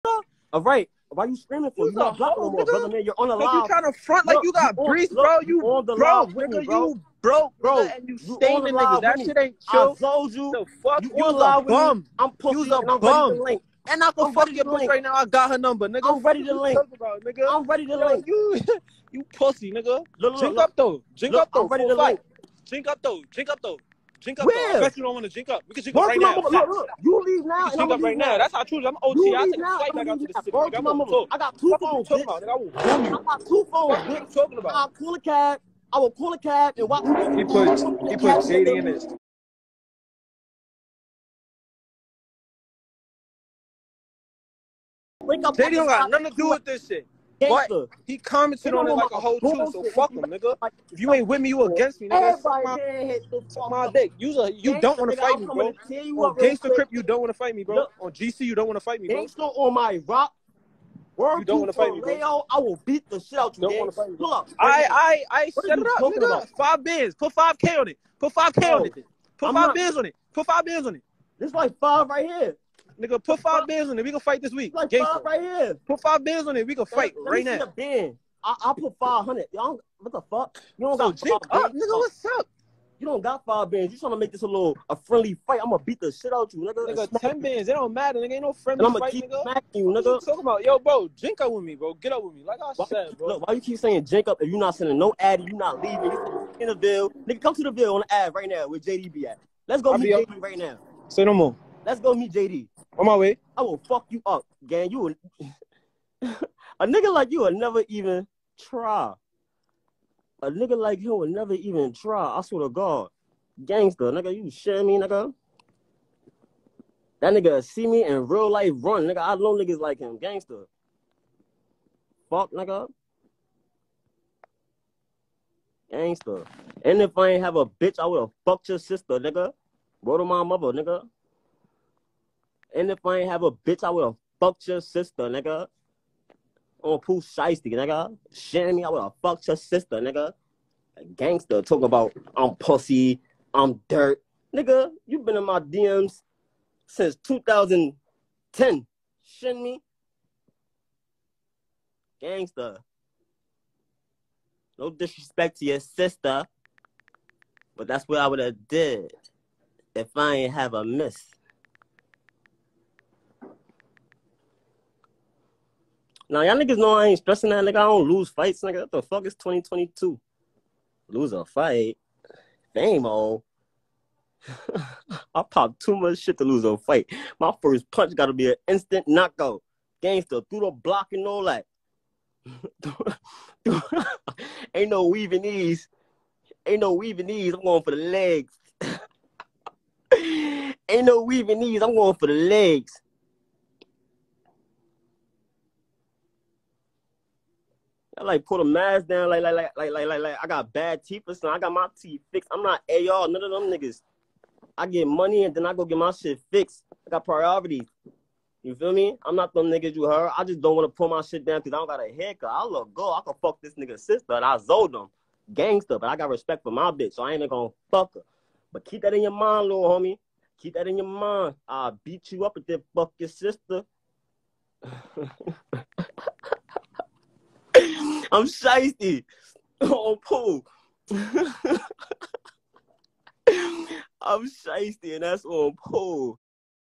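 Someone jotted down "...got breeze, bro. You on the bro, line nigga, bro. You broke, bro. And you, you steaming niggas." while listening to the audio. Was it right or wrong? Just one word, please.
right.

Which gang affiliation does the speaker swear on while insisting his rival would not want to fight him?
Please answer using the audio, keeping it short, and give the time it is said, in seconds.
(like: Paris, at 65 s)
Gangster Crip, at 56 s.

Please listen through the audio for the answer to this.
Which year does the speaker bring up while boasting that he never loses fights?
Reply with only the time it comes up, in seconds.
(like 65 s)
169 s.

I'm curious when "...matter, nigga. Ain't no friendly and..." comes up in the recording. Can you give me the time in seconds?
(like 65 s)
87 s.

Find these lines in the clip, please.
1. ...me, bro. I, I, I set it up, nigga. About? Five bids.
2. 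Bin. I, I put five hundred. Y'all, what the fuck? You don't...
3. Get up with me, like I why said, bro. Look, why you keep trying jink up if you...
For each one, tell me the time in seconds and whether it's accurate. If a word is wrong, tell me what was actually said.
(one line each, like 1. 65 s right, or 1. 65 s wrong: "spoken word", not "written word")
1. 64 s right
2. 77 s right
3. 91 s wrong: "saying", not "trying".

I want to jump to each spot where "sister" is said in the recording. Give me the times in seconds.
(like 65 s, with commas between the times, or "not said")
128 s, 134 s, 139 s, 155 s, 213 s, 223 s.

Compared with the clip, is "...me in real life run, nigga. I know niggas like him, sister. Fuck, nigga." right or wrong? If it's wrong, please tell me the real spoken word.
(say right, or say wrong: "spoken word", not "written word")
wrong: "gangster", not "sister".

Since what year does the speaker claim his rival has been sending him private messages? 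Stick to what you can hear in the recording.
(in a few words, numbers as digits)
2010.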